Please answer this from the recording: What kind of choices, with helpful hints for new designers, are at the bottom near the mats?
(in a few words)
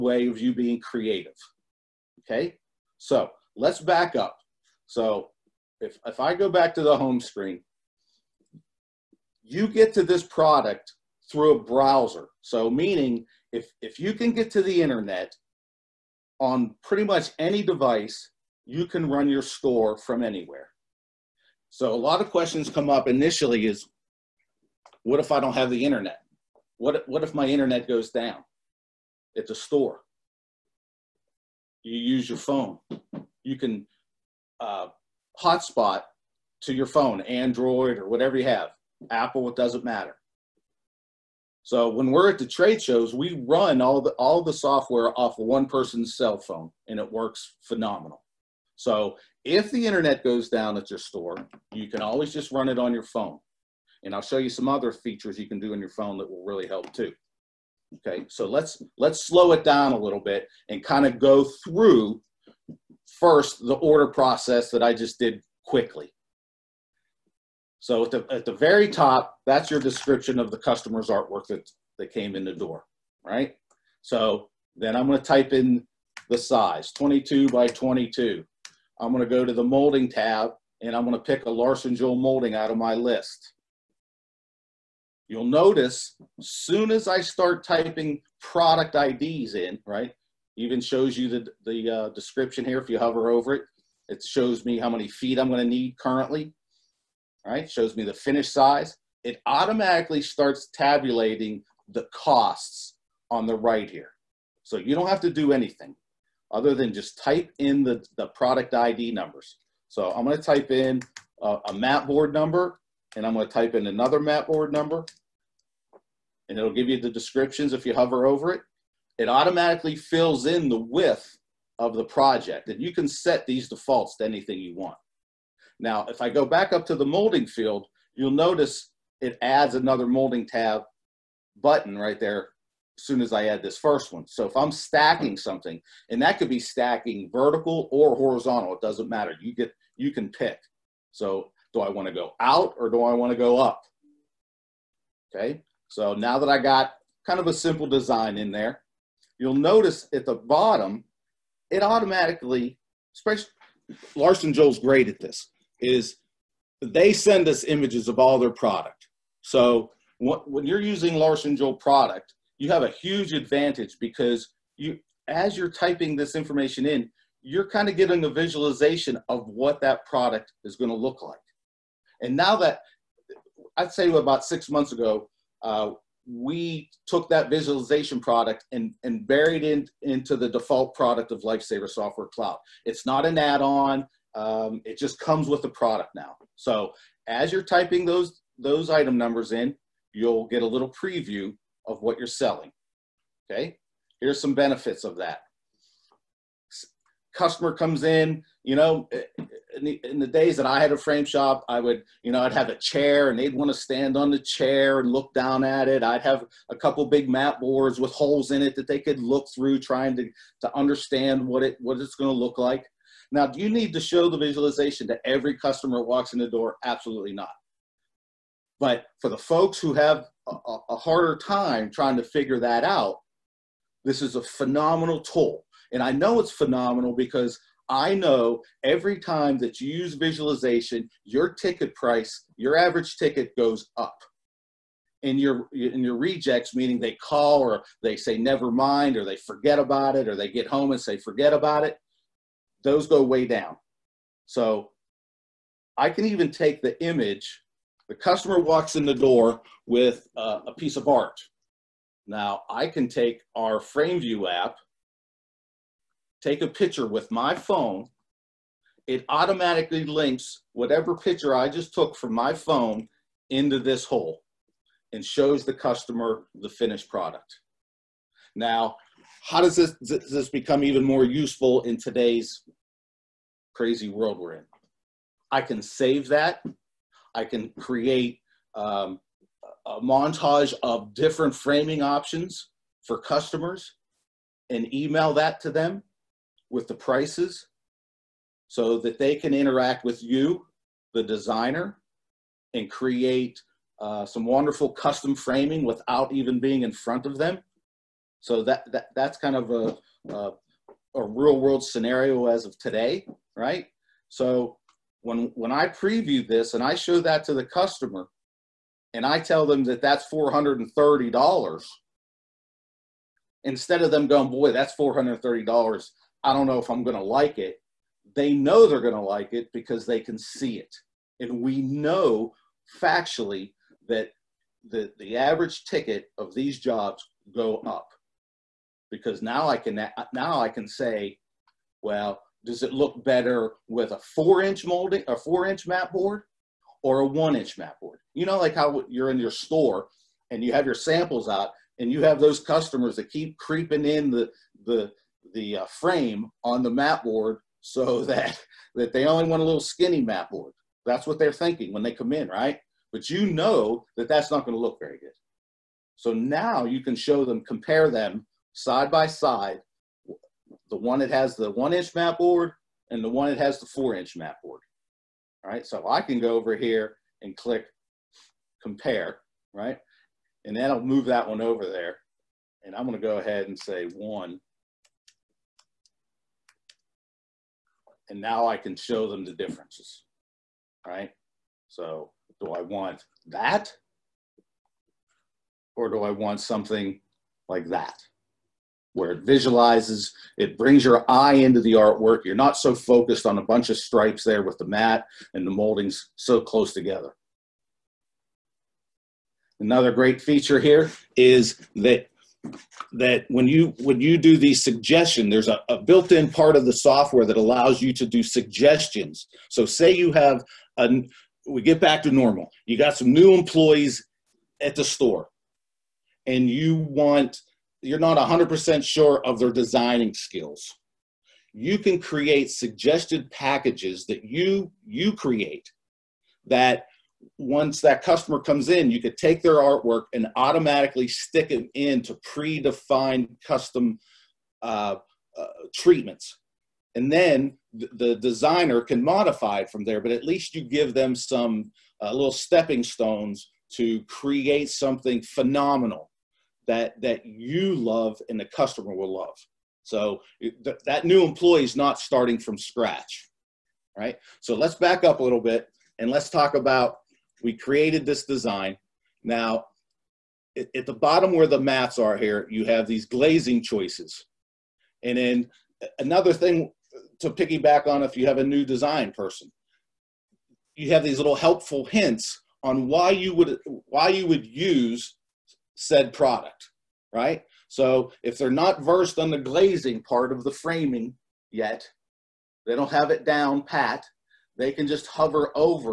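Glazing choices.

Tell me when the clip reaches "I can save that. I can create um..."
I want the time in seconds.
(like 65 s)
275 s.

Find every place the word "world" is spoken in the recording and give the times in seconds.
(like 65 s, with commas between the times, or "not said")
274 s, 301 s.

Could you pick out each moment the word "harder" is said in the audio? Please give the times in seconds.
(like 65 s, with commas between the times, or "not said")
220 s.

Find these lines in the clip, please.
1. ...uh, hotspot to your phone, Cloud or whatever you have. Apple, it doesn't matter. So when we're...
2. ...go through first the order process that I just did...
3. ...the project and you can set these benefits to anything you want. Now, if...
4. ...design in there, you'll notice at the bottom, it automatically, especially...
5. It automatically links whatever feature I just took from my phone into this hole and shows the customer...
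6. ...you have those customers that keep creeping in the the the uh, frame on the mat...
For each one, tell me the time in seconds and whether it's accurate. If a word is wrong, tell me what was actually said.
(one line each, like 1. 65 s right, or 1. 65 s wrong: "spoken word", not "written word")
1. 34 s wrong: "Android", not "Cloud"
2. 61 s right
3. 121 s wrong: "defaults", not "benefits"
4. 147 s right
5. 259 s wrong: "picture", not "feature"
6. 342 s right.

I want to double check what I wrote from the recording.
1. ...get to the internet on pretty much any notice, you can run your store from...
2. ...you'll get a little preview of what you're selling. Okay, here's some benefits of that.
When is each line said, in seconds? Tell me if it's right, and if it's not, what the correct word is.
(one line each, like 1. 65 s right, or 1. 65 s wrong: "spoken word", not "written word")
1. 14 s wrong: "device", not "notice"
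2. 190 s right.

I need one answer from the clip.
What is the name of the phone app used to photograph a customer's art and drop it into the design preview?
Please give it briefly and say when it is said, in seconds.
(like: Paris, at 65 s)
FrameView, at 253 s.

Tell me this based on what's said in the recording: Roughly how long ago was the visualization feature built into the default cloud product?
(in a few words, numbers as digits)
About six months ago.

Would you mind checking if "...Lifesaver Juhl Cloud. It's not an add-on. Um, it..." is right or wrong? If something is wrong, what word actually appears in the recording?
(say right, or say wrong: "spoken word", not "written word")
wrong: "Software", not "Juhl".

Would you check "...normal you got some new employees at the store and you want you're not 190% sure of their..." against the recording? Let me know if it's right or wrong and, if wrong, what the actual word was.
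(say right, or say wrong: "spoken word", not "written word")
wrong: "100", not "190".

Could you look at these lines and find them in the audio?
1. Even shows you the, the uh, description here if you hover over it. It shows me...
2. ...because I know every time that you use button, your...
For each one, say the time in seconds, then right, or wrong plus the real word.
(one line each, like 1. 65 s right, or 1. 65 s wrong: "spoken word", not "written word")
1. 90 s right
2. 227 s wrong: "visualization", not "button".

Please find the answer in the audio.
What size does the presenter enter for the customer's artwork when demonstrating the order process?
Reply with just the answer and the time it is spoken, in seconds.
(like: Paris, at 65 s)
22 by 22, at 76 s.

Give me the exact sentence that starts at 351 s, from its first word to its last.
That's what they're thinking when they come in, right?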